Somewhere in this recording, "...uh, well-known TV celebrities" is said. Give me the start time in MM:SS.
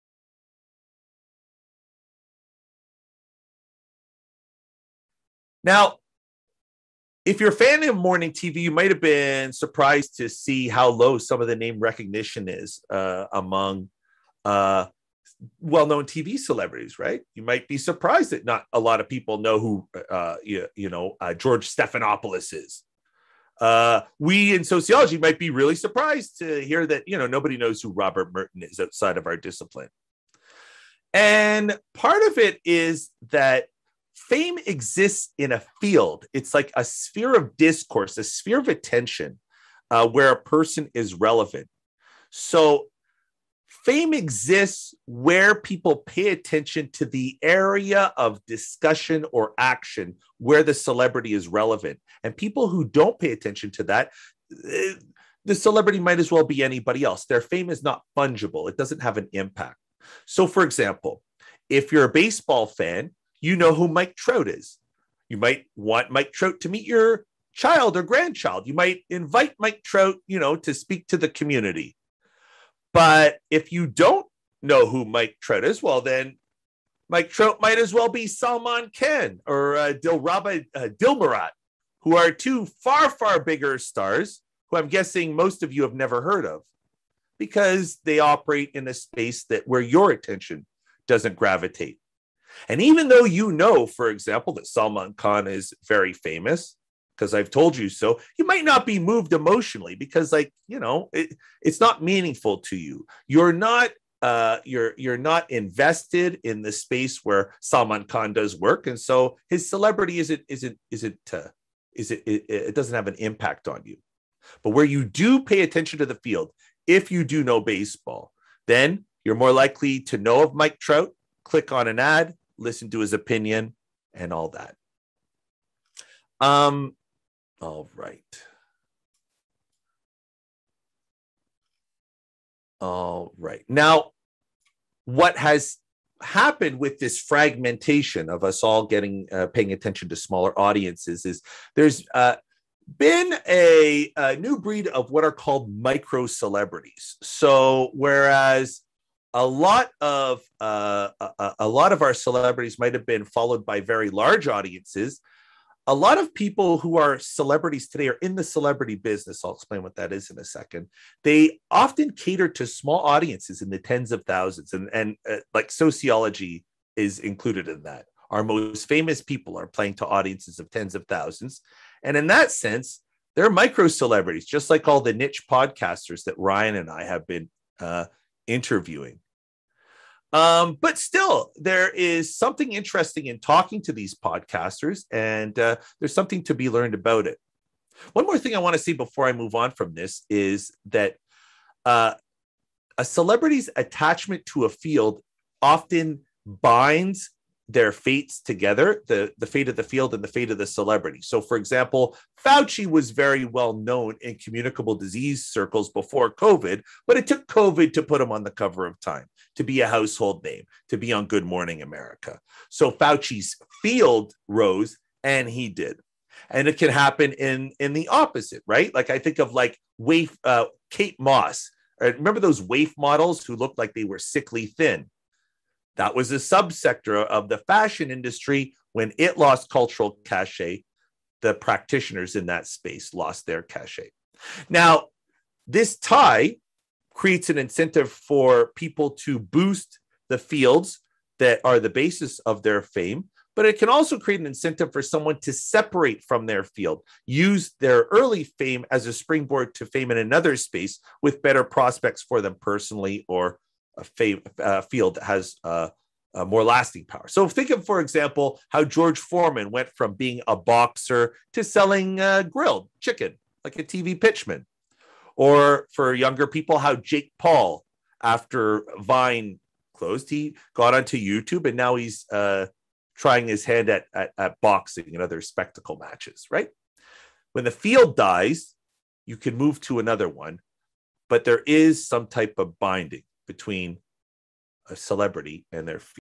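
00:14.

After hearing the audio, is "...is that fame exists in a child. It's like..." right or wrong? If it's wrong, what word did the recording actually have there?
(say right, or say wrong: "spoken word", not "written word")
wrong: "field", not "child".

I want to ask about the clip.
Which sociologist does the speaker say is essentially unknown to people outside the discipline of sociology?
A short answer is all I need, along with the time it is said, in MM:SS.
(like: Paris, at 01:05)
Robert Merton, at 00:27.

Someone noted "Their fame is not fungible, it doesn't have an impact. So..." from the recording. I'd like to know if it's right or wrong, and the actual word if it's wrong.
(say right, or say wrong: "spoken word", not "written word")
right.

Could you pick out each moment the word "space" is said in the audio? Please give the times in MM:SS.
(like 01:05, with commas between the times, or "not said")
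01:28, 01:46, 03:52, 04:10.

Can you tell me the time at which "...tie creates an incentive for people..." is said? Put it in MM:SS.
03:55.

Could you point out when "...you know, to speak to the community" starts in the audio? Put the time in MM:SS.
01:10.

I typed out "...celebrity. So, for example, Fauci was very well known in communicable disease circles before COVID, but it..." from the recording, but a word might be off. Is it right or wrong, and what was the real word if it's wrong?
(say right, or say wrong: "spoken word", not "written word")
right.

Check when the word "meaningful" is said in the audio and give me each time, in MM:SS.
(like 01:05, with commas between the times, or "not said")
01:42.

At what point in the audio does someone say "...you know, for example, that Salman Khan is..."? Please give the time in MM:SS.
01:33.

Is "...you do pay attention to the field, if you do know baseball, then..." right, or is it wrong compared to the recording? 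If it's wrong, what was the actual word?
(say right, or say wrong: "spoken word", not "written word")
right.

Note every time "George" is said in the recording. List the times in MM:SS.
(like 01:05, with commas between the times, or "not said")
00:21, 04:18.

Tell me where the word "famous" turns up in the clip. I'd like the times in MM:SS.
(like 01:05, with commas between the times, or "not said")
01:36, 02:48.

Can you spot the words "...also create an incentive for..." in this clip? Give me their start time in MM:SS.
04:03.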